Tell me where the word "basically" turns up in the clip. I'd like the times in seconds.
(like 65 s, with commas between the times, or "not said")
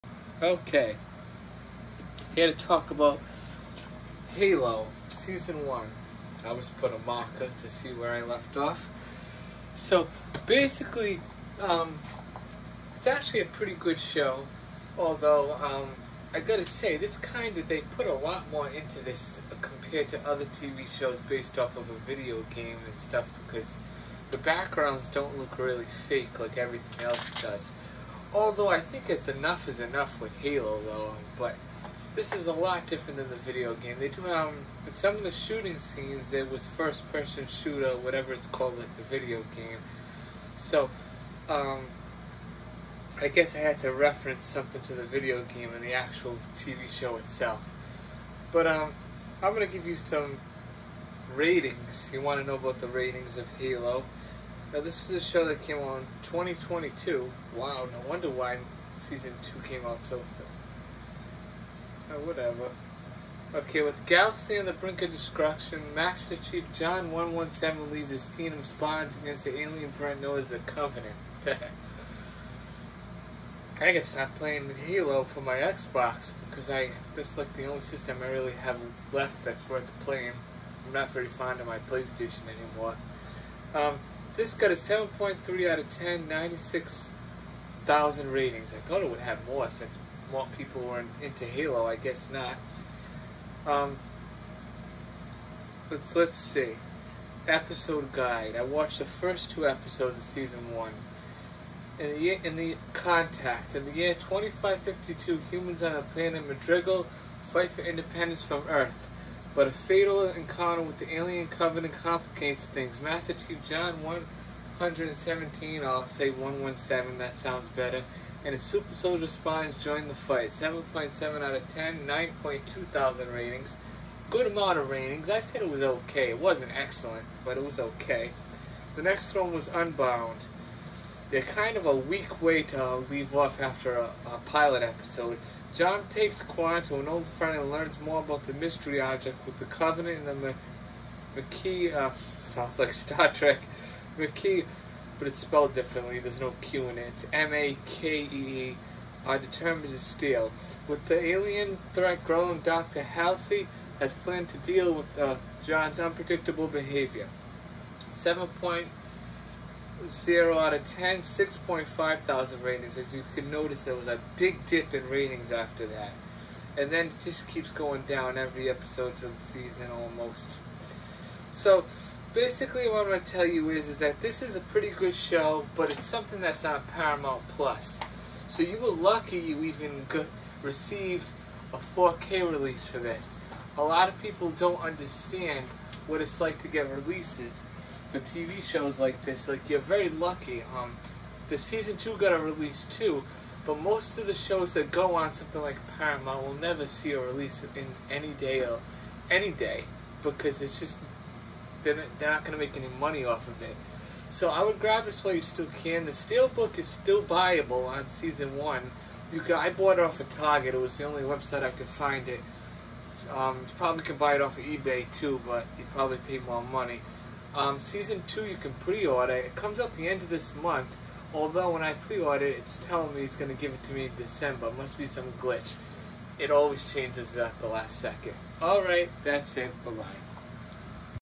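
10 s, 172 s.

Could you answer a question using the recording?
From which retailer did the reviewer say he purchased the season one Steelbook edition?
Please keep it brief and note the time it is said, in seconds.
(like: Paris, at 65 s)
Target, at 210 s.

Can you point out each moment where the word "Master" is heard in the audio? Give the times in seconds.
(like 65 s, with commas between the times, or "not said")
65 s, 113 s.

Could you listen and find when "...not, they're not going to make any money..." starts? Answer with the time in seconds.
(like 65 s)
201 s.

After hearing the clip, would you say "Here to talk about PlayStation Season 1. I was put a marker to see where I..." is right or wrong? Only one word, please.
wrong.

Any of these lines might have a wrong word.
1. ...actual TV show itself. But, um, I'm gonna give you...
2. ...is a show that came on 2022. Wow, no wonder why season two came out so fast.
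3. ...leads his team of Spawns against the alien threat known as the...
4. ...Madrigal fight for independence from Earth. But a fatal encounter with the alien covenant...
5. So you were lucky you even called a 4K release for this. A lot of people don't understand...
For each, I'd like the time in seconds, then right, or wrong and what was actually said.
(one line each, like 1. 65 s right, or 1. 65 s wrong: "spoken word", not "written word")
1. 45 s right
2. 55 s right
3. 67 s right
4. 106 s right
5. 178 s wrong: "received", not "called".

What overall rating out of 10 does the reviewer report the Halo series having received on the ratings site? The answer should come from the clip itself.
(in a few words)
7.3.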